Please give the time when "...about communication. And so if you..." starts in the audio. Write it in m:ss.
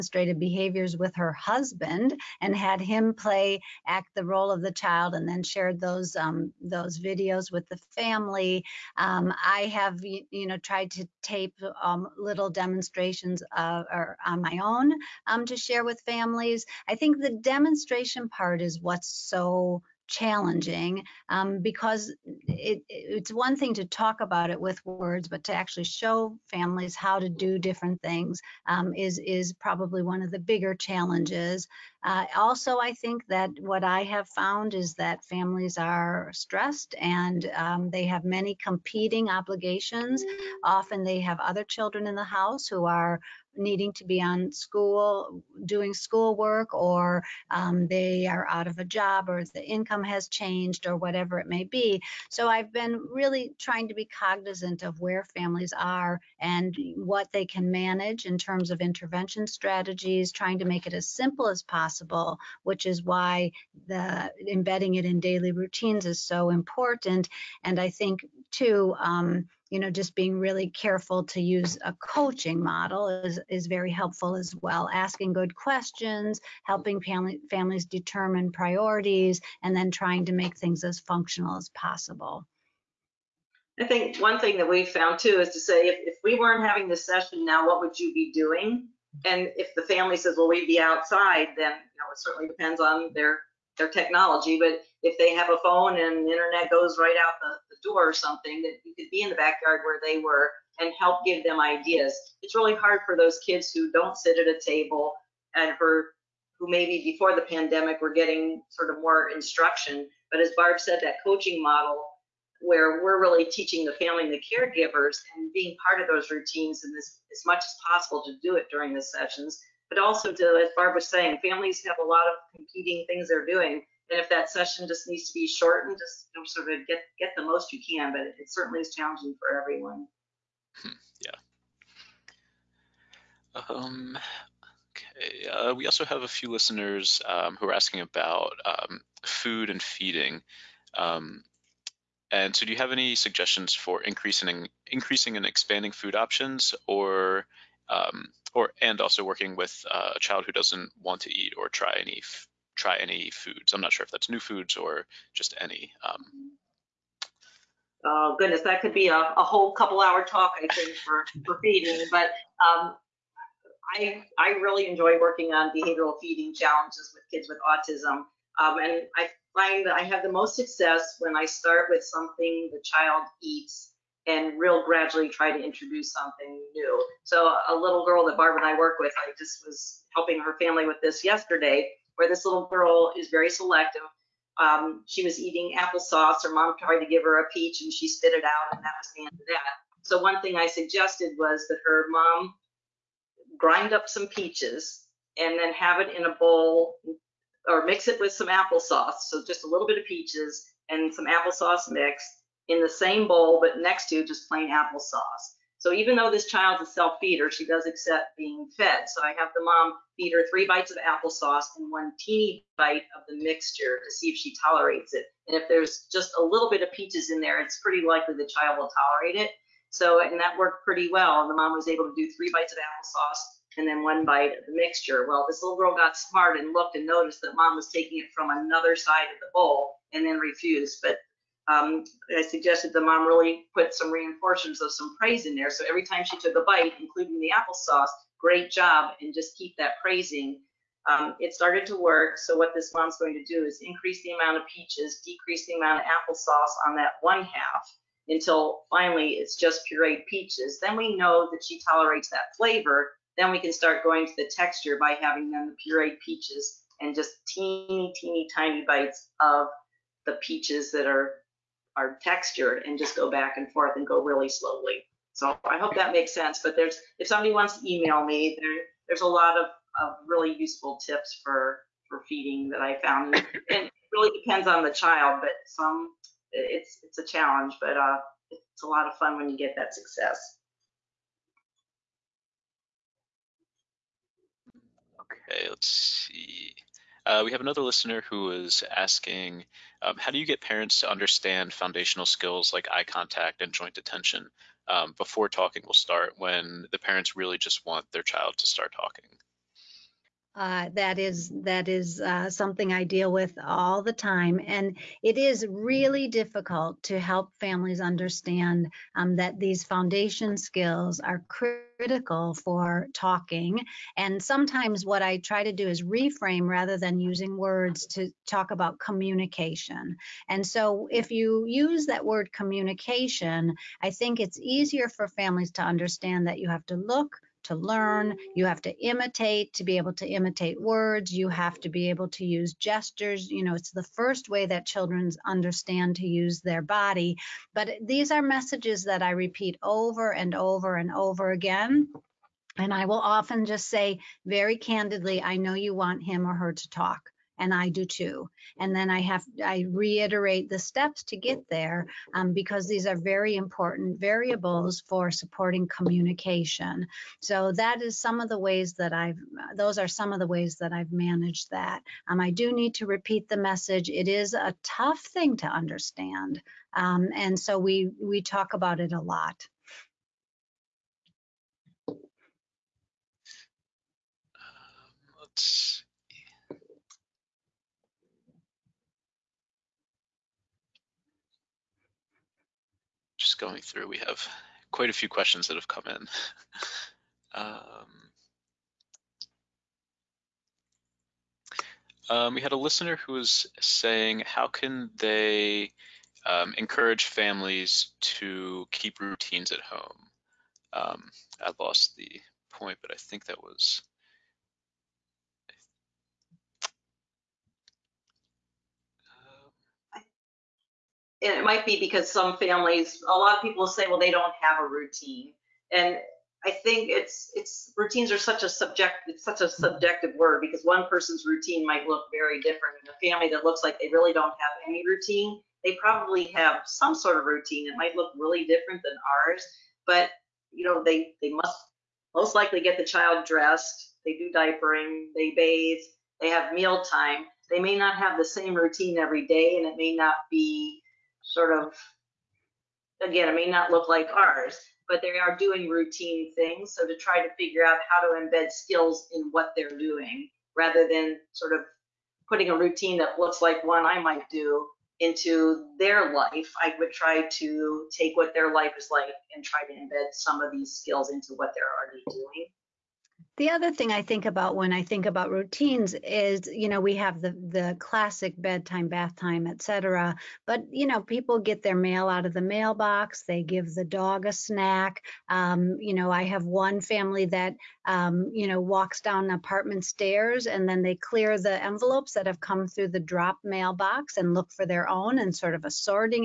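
5:18.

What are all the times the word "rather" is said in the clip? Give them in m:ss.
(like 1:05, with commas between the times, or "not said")
5:16, 7:30.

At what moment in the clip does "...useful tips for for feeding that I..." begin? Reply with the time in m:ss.
4:30.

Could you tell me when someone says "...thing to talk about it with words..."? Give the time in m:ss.
0:23.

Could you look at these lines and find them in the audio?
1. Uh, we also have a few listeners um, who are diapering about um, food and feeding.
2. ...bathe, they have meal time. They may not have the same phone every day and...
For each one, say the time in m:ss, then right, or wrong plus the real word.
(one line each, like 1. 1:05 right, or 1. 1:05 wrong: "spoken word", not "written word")
1. 2:15 wrong: "asking", not "diapering"
2. 7:15 wrong: "routine", not "phone".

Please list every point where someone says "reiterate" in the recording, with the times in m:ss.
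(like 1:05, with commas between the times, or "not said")
5:49.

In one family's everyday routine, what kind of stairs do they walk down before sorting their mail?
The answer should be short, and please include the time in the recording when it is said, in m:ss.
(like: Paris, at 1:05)
Apartment stairs, at 7:59.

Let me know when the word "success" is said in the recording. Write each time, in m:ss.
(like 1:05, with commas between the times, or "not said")
2:50, 4:39.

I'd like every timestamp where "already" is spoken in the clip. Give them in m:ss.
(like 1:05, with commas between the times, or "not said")
7:42.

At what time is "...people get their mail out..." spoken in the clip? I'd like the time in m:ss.
7:51.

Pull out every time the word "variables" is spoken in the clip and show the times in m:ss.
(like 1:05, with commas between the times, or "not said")
5:54.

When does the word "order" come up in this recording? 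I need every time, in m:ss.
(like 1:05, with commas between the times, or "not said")
not said.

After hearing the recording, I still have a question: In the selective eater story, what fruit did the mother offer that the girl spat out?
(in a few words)
Peach.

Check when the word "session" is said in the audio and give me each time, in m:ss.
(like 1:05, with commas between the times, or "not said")
1:27, 1:59, 2:04.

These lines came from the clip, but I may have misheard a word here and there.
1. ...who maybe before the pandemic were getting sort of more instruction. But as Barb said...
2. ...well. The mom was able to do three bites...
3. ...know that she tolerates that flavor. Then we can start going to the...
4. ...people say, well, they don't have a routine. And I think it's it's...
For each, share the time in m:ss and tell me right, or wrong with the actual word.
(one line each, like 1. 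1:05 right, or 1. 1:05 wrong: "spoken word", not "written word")
1. 1:46 right
2. 3:41 right
3. 4:11 right
4. 6:53 right.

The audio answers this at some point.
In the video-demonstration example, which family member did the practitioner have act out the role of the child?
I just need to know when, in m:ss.
0:01.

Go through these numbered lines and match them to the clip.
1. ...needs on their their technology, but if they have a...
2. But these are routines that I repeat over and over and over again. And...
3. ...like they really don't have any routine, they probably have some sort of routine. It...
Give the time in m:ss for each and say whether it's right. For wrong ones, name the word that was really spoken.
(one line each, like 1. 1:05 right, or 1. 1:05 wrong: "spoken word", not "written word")
1. 1:32 wrong: "depends", not "needs"
2. 5:37 wrong: "messages", not "routines"
3. 7:03 right.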